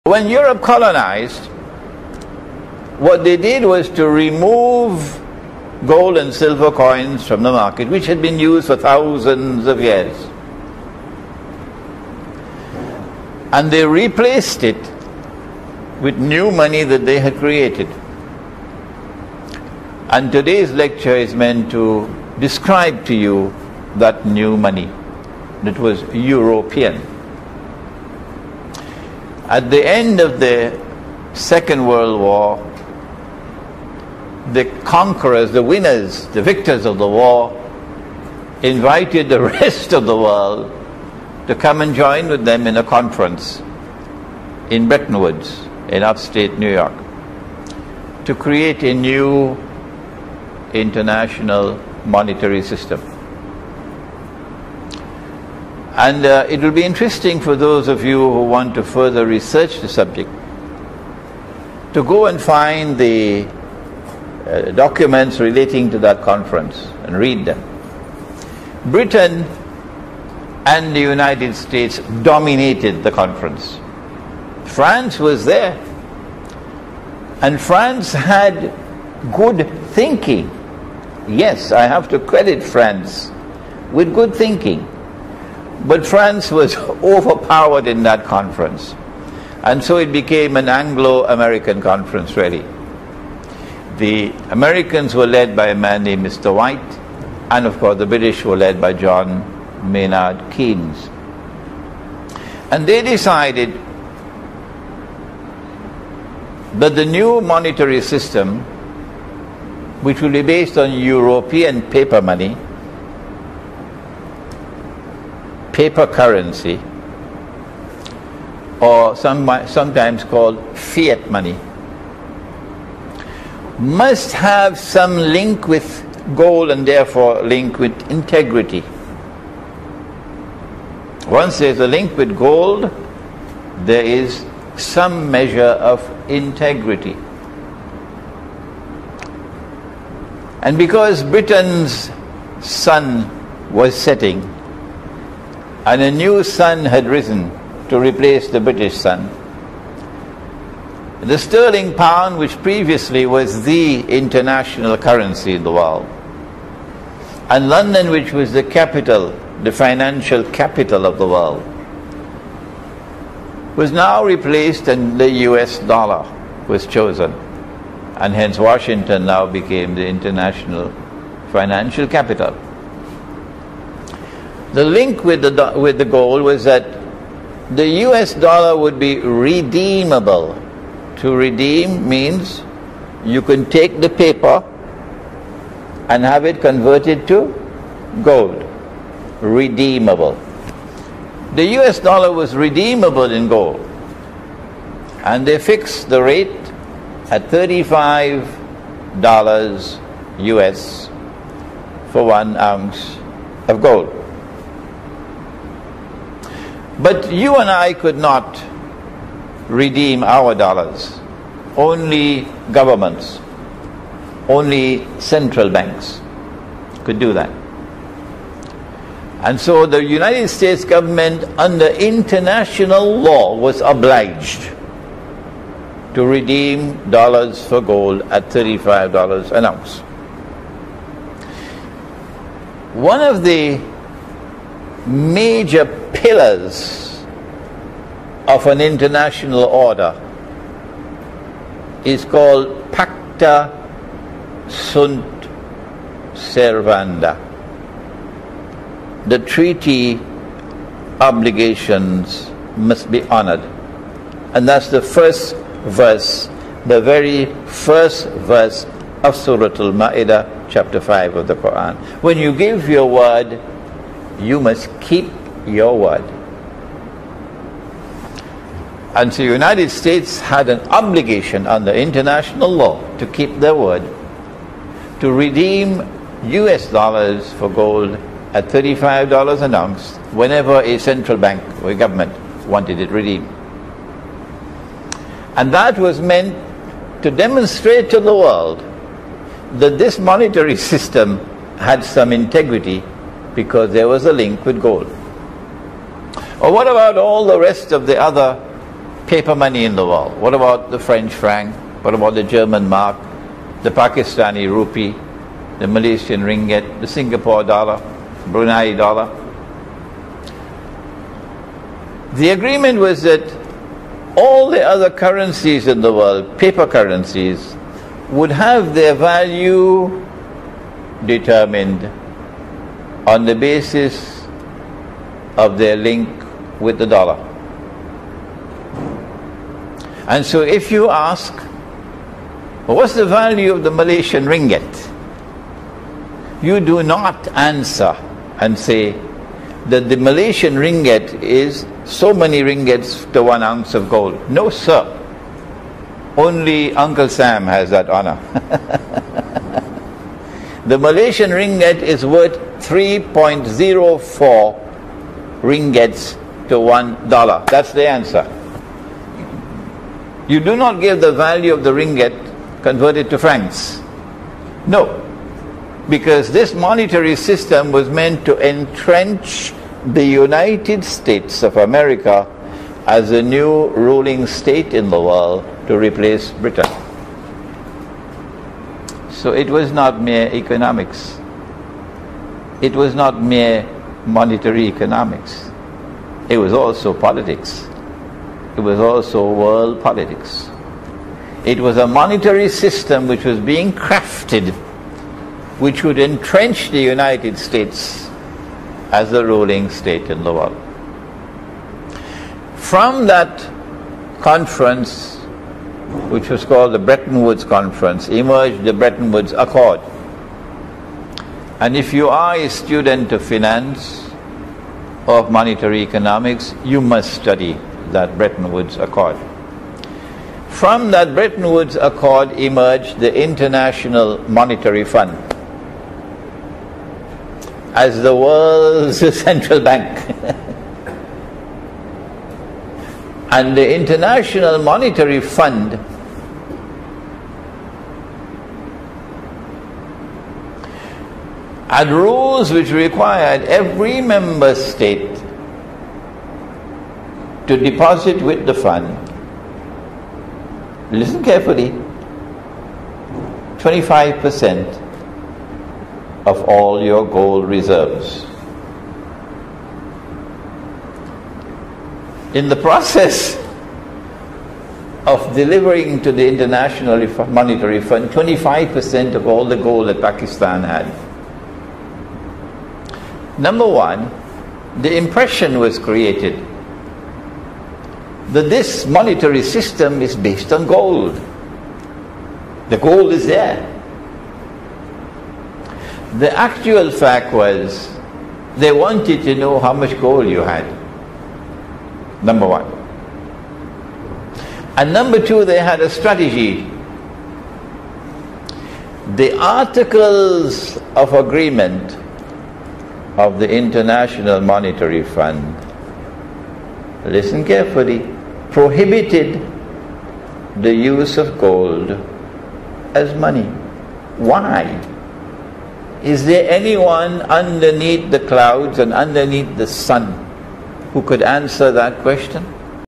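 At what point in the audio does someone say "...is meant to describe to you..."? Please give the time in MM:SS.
00:21.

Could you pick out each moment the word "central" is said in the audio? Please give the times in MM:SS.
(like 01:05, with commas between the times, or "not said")
03:35, 04:40, 07:09.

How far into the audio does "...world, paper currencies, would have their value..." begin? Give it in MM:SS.
05:16.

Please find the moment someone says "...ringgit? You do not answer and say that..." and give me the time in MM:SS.
05:34.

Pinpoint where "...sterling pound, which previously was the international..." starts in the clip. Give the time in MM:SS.
02:31.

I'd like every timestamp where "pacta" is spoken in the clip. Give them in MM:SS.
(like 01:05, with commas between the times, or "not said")
04:02.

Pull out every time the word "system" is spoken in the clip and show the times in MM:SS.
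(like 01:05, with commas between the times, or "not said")
00:52, 01:48, 04:50, 06:07, 06:32, 07:59.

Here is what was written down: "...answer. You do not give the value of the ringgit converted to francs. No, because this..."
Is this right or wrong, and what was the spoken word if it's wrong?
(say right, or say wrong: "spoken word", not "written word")
right.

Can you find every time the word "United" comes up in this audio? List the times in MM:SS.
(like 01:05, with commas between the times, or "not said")
01:11, 03:40, 04:29, 06:10, 06:37.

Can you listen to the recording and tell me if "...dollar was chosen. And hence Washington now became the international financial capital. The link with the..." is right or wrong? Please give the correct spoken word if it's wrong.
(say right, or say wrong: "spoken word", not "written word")
right.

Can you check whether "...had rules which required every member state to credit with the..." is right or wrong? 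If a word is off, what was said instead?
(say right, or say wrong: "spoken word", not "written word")
wrong: "deposit", not "credit".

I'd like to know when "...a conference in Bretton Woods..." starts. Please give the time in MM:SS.
00:42.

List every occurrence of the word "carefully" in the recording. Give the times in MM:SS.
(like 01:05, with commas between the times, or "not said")
07:31, 08:27.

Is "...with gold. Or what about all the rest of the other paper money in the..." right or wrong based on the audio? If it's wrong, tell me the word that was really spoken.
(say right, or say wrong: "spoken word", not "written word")
right.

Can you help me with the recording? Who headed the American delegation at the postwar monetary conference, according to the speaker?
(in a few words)
Mr. White.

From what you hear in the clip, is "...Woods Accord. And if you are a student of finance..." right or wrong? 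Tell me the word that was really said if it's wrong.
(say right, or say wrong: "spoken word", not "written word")
right.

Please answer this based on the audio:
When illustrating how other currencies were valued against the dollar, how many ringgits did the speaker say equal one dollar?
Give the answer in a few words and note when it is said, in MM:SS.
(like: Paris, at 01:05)
3.04, at 05:52.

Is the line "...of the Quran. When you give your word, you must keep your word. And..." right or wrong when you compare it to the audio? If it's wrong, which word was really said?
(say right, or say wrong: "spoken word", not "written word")
right.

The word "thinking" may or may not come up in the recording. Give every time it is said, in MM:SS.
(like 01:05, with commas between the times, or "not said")
01:19, 01:24.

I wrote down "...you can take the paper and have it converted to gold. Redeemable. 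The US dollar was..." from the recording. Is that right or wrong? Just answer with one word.
right.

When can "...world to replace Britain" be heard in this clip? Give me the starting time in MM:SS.
06:15.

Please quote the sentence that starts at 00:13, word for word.
And they replaced it with new money that they had created.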